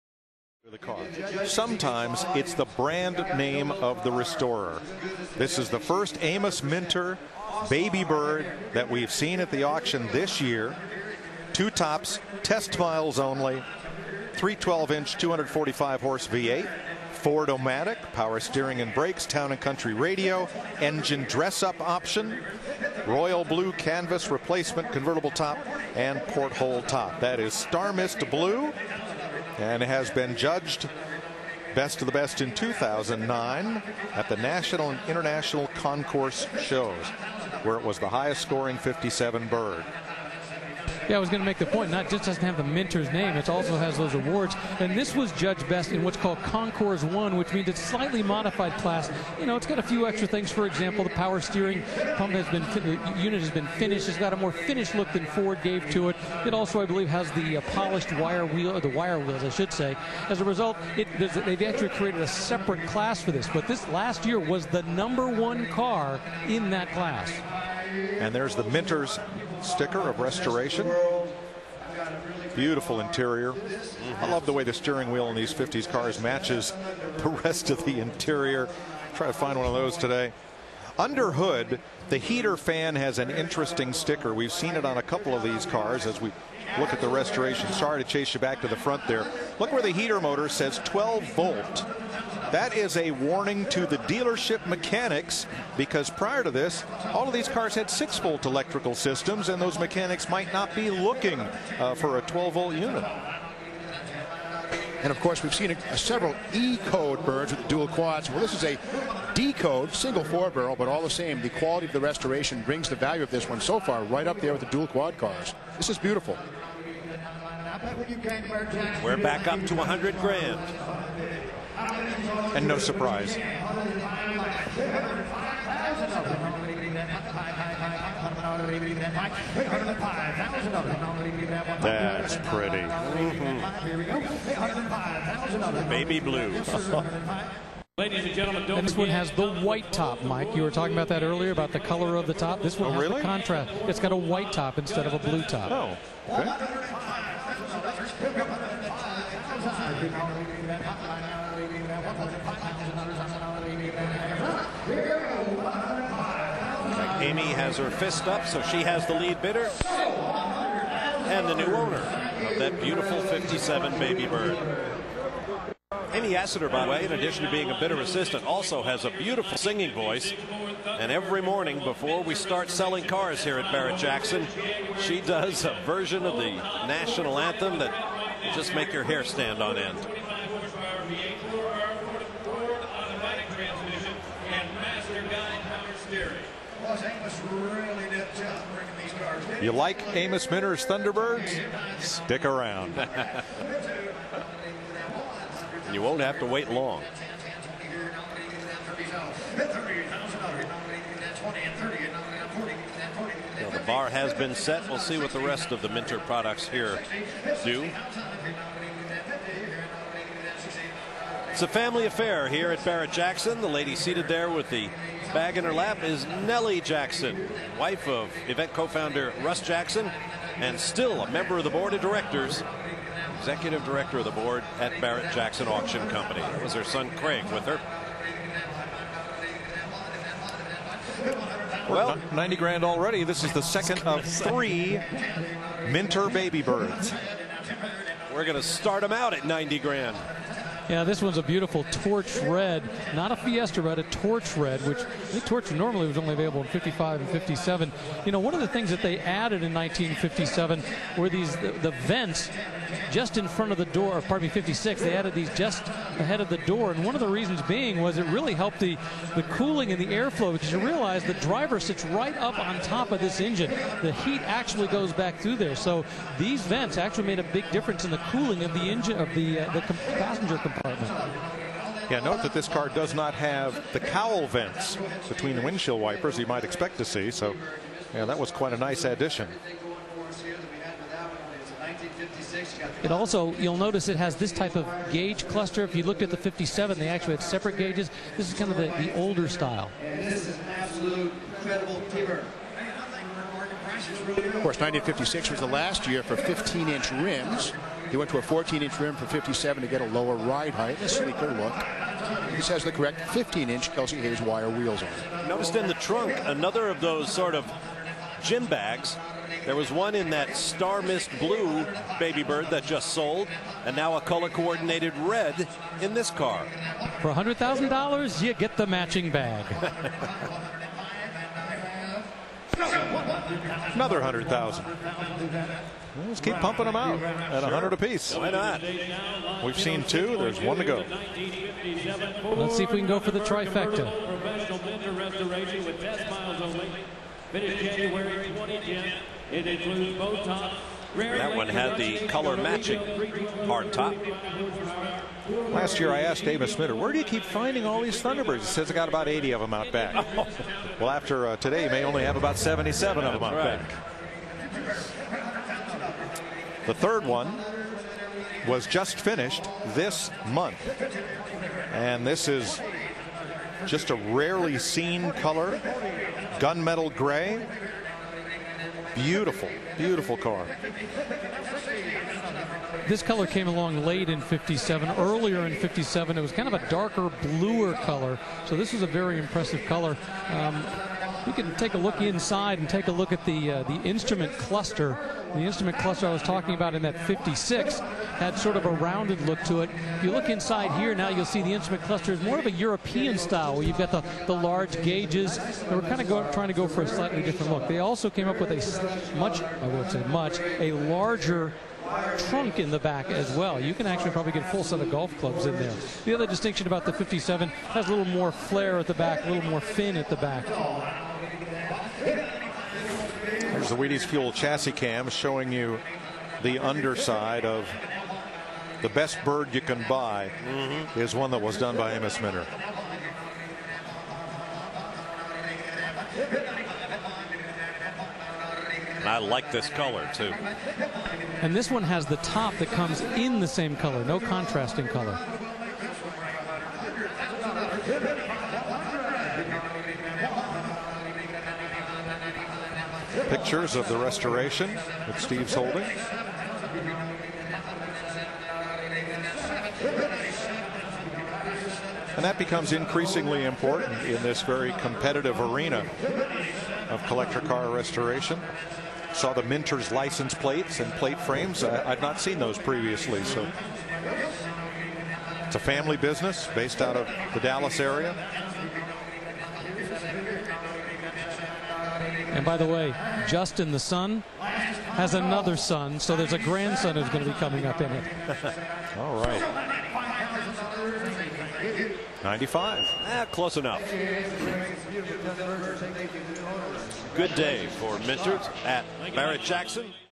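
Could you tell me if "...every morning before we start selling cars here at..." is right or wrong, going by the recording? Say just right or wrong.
right.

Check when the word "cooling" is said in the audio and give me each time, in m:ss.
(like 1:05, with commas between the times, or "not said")
4:19, 4:28.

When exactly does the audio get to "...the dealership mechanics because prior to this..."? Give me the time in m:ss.
1:33.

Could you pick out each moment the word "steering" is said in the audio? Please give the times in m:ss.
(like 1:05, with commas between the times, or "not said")
0:18, 0:51, 1:14, 3:06.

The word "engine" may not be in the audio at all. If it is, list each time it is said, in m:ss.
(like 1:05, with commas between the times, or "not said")
0:20, 4:23, 4:28.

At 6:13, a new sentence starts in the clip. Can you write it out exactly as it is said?
This color came along late in 57.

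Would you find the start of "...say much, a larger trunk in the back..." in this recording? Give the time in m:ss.
6:40.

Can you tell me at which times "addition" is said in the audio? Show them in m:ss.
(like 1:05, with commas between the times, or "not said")
2:47, 4:39.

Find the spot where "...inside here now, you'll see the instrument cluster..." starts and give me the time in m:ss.
6:30.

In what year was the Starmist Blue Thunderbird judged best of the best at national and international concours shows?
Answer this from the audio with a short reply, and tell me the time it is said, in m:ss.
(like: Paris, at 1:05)
2009, at 0:32.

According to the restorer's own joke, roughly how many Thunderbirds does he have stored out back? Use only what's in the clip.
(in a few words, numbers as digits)
80.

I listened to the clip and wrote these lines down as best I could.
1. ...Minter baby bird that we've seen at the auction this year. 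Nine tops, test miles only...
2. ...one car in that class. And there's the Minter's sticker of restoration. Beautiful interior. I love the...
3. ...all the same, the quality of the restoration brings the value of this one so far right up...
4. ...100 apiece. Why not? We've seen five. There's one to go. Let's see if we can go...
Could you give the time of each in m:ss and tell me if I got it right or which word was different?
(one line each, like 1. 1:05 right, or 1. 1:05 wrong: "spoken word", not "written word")
1. 0:06 wrong: "Two", not "Nine"
2. 1:05 right
3. 1:50 right
4. 5:27 wrong: "two", not "five".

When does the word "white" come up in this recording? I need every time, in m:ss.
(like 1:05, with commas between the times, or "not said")
2:19, 2:24.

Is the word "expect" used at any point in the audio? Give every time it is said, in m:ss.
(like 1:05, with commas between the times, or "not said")
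4:36.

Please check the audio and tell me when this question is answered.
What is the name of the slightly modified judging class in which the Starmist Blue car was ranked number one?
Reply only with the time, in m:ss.
0:46.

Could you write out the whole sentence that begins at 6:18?
So this is a very impressive color.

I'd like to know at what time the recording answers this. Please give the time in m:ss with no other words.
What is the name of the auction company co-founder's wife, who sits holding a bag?
3:36.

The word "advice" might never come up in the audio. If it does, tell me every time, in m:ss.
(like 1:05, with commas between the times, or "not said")
not said.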